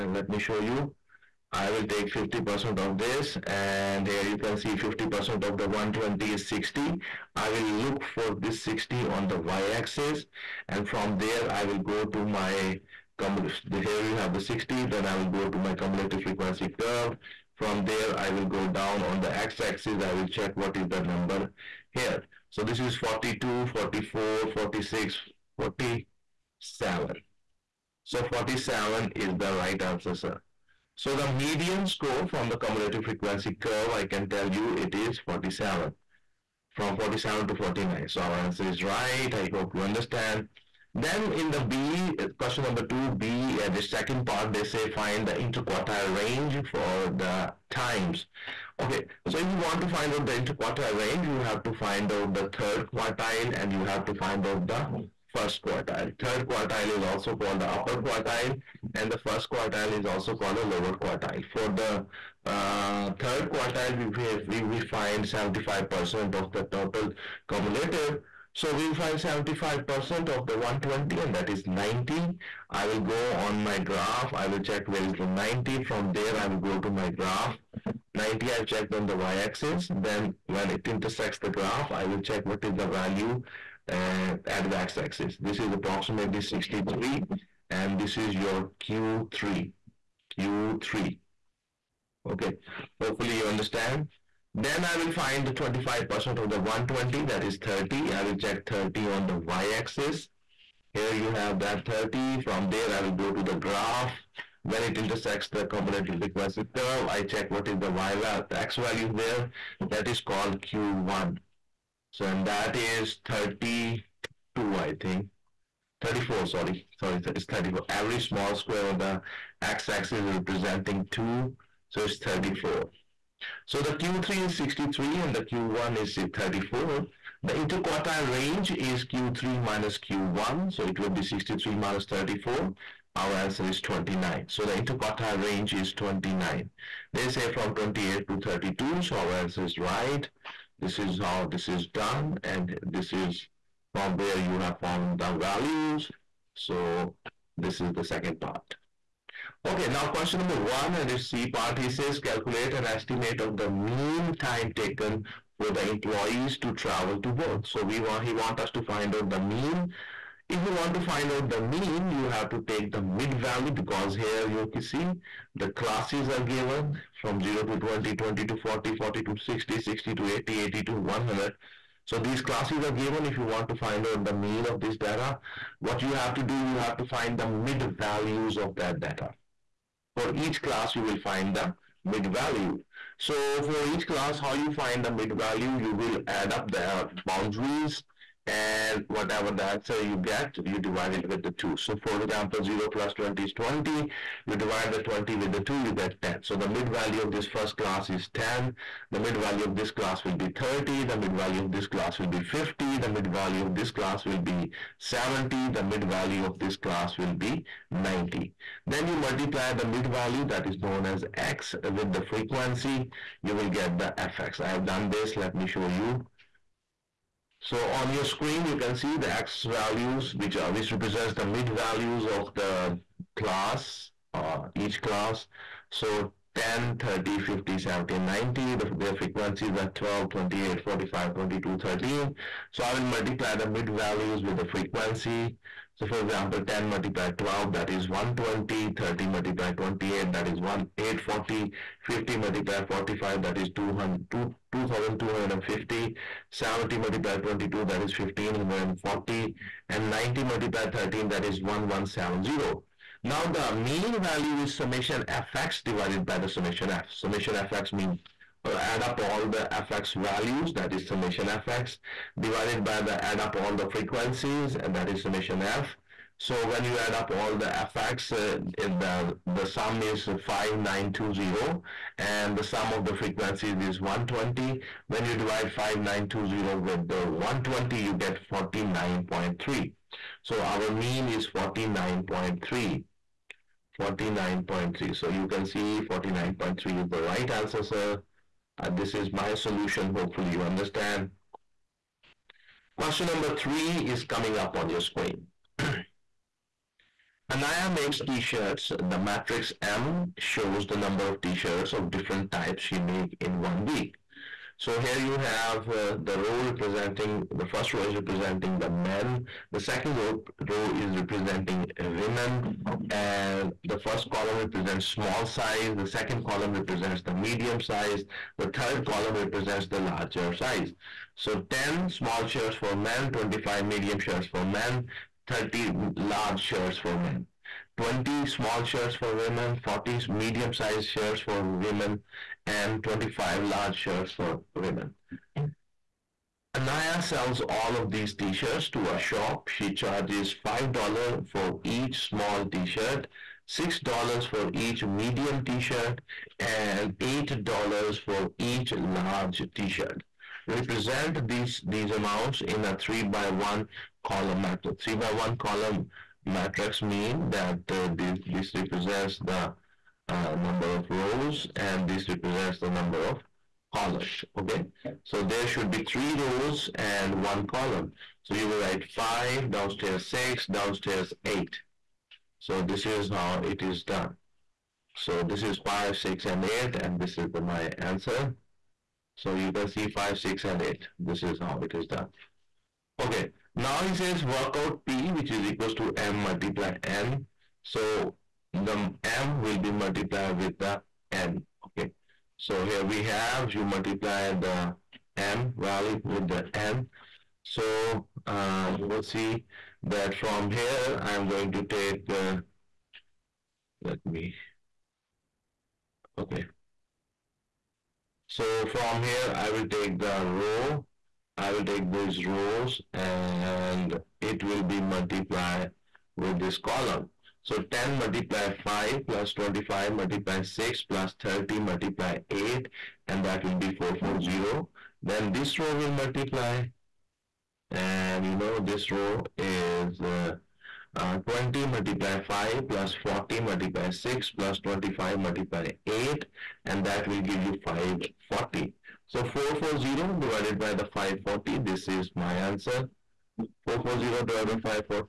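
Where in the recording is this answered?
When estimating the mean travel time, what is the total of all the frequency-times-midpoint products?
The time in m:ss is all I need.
4:29.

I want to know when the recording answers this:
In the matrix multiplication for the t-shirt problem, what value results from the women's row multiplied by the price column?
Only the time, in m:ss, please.
7:17.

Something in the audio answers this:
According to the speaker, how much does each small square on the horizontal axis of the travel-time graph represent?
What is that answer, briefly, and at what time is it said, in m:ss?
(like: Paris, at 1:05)
2, at 2:00.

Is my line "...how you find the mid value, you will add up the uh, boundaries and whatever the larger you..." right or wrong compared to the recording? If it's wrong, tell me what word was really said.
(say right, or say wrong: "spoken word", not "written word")
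wrong: "answer", not "larger".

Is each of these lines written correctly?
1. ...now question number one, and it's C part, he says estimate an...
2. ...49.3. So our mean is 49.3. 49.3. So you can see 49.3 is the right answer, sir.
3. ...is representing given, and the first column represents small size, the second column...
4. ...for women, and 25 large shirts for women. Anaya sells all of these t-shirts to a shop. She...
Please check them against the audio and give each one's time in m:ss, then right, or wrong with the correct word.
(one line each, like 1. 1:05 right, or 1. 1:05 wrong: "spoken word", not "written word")
1. 2:29 wrong: "calculate", not "estimate"
2. 4:38 right
3. 5:10 wrong: "women", not "given"
4. 5:31 right.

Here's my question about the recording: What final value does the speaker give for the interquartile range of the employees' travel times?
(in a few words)
29.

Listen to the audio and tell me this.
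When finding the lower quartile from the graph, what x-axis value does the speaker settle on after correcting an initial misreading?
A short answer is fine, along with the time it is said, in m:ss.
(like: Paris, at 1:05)
34, at 1:56.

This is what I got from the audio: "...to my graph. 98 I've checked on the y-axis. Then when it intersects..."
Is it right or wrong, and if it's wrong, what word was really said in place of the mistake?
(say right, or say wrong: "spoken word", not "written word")
wrong: "90", not "98".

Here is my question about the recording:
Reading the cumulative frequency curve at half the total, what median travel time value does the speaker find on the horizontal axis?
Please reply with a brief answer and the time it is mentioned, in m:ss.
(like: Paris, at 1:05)
47, at 0:28.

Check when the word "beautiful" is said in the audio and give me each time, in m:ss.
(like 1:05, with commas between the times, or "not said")
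not said.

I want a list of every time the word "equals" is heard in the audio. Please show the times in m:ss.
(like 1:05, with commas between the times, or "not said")
6:25.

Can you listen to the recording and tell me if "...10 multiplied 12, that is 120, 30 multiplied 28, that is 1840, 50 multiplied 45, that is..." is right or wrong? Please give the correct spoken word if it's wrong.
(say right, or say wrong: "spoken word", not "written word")
right.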